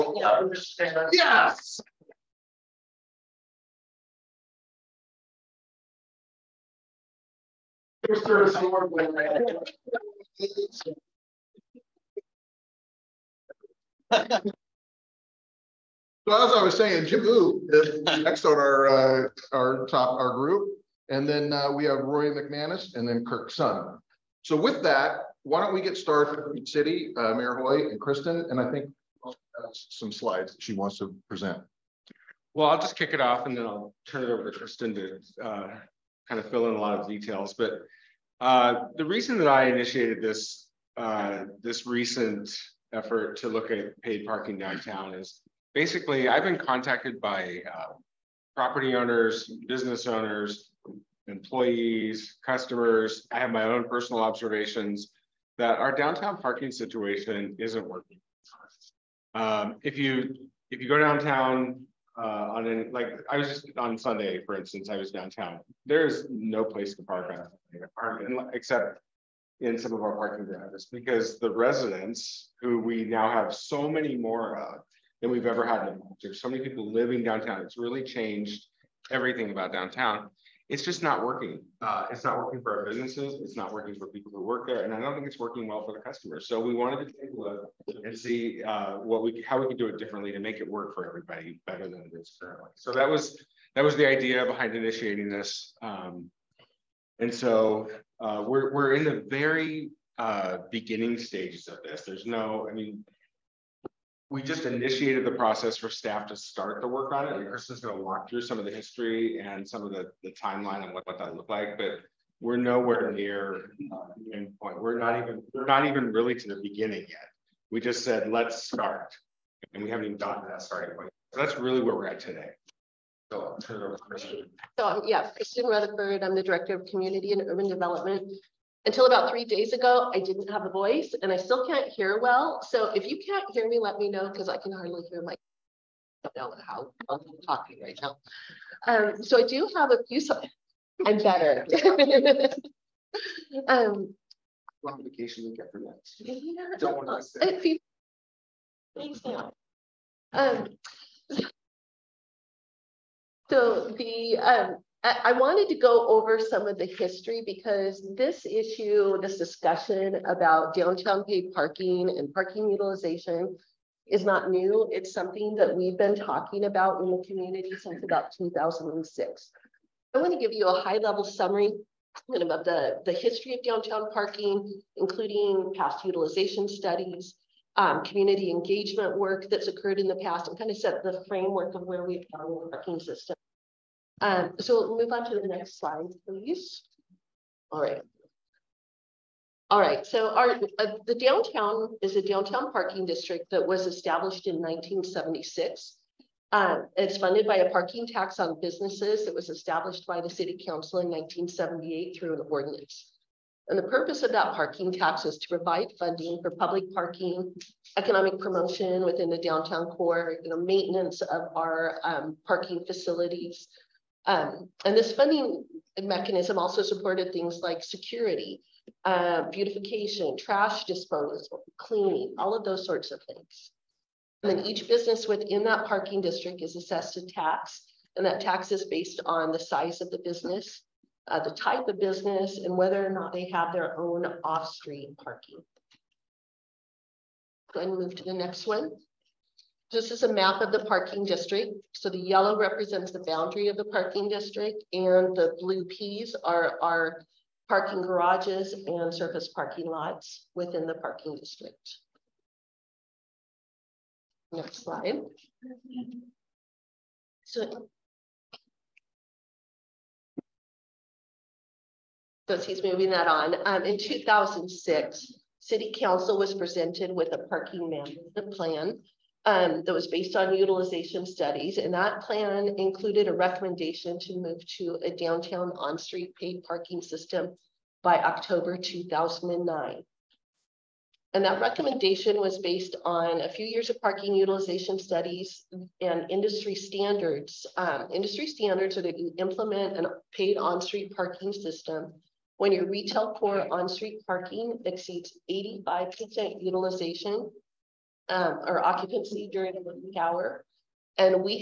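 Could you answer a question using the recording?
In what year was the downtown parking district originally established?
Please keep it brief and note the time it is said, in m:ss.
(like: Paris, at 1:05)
1976, at 3:14.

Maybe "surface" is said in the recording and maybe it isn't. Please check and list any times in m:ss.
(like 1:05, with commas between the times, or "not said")
4:09.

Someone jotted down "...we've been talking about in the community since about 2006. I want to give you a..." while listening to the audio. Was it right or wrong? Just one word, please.
right.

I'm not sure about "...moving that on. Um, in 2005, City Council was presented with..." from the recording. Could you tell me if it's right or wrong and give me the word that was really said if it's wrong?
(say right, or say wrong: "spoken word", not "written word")
wrong: "2006", not "2005".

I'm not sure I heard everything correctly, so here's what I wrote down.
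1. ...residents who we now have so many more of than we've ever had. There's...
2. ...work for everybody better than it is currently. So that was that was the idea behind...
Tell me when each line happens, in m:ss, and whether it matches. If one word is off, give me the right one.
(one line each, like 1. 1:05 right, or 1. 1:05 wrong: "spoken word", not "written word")
1. 1:11 right
2. 1:30 right.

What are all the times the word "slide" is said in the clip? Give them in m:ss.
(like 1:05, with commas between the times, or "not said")
0:30, 3:05, 4:14.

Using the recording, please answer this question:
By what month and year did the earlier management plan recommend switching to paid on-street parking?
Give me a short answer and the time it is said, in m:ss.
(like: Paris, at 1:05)
October 2009, at 4:38.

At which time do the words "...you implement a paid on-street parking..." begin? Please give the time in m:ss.
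4:49.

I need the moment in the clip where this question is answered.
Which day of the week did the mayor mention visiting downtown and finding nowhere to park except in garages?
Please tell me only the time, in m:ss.
1:03.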